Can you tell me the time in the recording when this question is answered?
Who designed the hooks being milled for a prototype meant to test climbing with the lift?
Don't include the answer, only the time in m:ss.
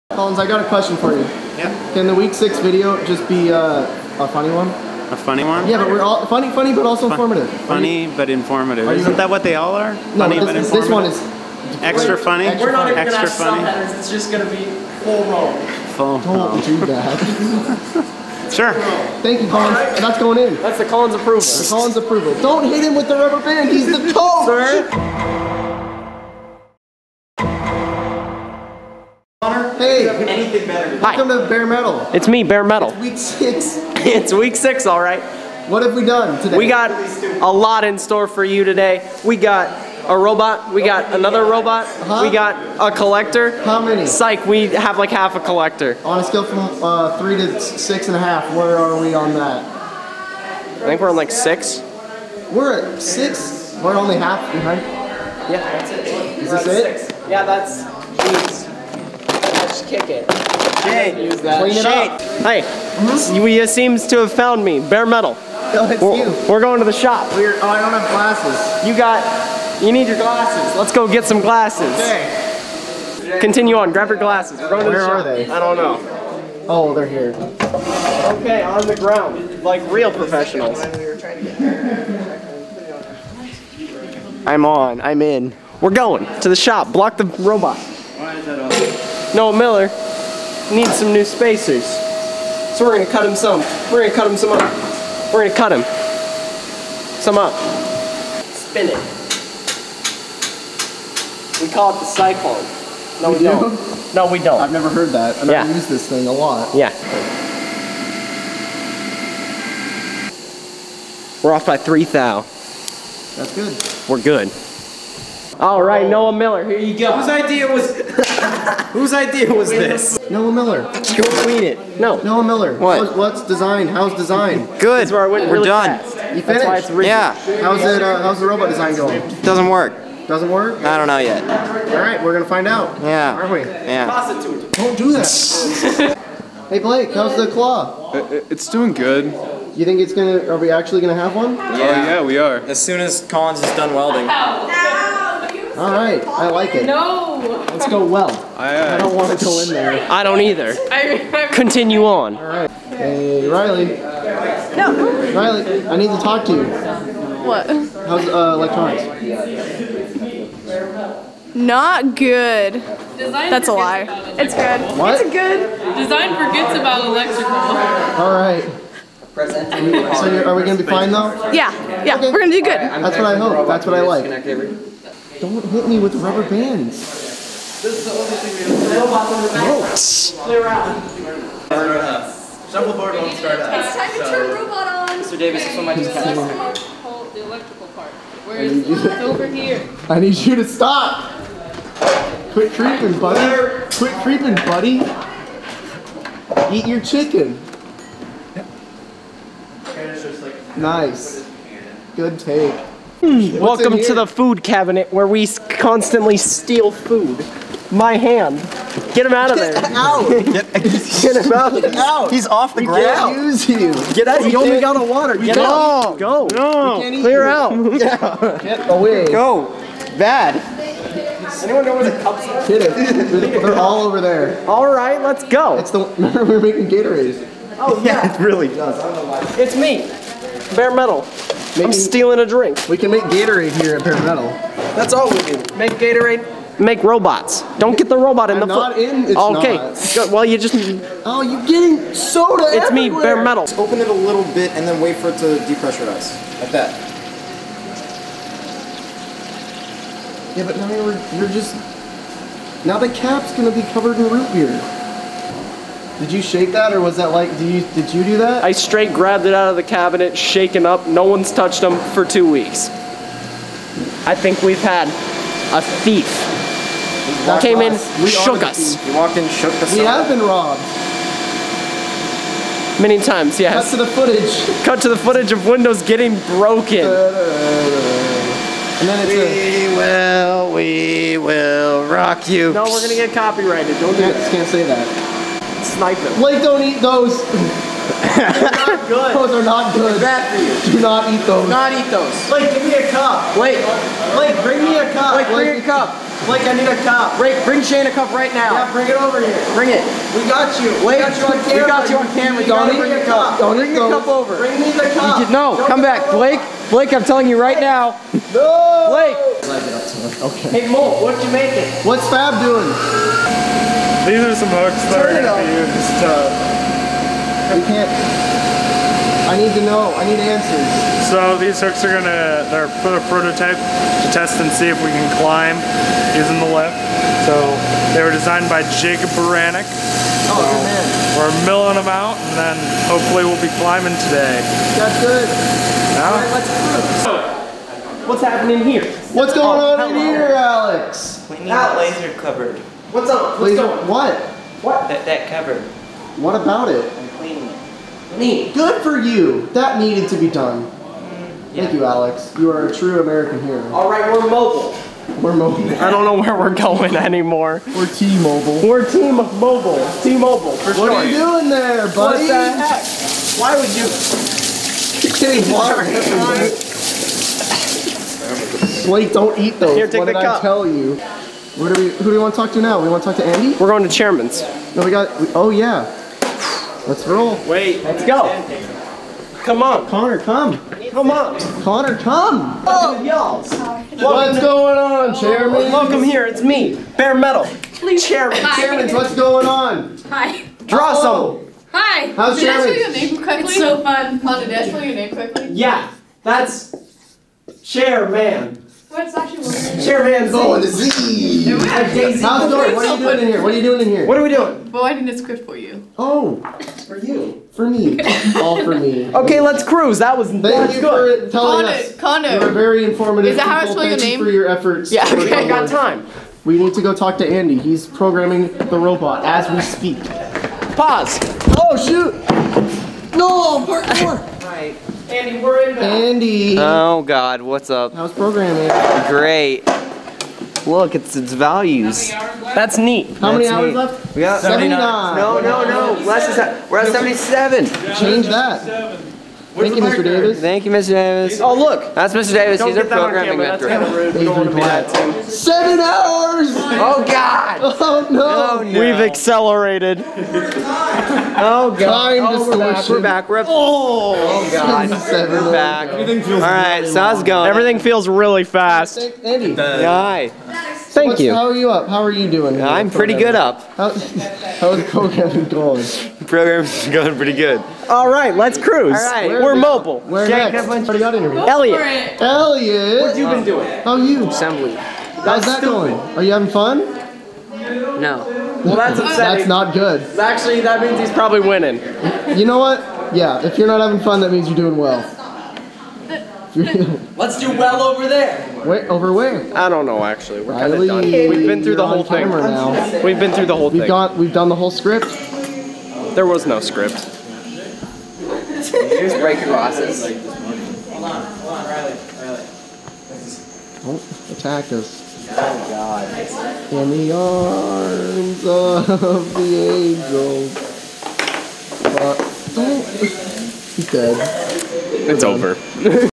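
5:29.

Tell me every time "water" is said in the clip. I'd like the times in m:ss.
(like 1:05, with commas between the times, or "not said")
3:35, 6:05.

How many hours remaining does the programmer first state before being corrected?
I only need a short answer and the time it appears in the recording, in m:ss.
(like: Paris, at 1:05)
79, at 7:14.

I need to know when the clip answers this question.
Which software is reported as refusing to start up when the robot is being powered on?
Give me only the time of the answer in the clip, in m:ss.
3:02.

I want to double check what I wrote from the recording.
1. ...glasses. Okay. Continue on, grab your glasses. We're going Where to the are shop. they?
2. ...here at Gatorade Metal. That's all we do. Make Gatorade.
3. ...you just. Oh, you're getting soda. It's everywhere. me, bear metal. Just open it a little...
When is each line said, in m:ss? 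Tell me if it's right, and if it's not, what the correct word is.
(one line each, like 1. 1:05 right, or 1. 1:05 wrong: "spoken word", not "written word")
1. 1:11 right
2. 3:53 wrong: "Bear", not "Gatorade"
3. 4:00 right.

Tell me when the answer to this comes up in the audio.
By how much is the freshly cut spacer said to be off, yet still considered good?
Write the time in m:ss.
1:51.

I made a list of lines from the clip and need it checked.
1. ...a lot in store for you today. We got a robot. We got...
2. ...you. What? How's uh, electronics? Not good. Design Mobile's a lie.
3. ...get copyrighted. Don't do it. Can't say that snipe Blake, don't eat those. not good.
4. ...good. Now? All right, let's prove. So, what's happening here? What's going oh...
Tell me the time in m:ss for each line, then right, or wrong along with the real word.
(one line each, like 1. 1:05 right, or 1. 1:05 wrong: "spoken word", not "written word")
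1. 0:37 right
2. 2:36 wrong: "That", not "Mobile"
3. 4:43 right
4. 5:35 right.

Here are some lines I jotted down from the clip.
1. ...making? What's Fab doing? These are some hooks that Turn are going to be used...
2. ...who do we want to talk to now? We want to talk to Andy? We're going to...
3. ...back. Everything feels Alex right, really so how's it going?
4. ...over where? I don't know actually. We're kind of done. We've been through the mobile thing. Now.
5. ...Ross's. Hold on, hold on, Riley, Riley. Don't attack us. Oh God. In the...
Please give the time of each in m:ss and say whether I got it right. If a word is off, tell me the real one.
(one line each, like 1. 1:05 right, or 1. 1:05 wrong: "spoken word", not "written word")
1. 5:11 right
2. 6:12 right
3. 7:35 wrong: "All", not "Alex"
4. 8:09 wrong: "whole", not "mobile"
5. 8:19 right.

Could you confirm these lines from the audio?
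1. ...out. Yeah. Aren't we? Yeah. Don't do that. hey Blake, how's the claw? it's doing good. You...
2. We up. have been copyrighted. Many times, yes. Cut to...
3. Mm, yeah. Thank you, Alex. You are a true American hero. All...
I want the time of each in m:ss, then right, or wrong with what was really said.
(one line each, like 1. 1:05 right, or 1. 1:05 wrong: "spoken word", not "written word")
1. 2:12 right
2. 4:29 wrong: "robbed", not "copyrighted"
3. 5:50 right.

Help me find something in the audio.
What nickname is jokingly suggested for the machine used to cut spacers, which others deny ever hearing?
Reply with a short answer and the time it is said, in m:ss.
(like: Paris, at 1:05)
the cyclone, at 1:41.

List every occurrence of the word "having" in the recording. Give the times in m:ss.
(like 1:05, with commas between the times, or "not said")
7:56, 8:03.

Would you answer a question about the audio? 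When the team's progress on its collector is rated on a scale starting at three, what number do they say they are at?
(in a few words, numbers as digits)
6.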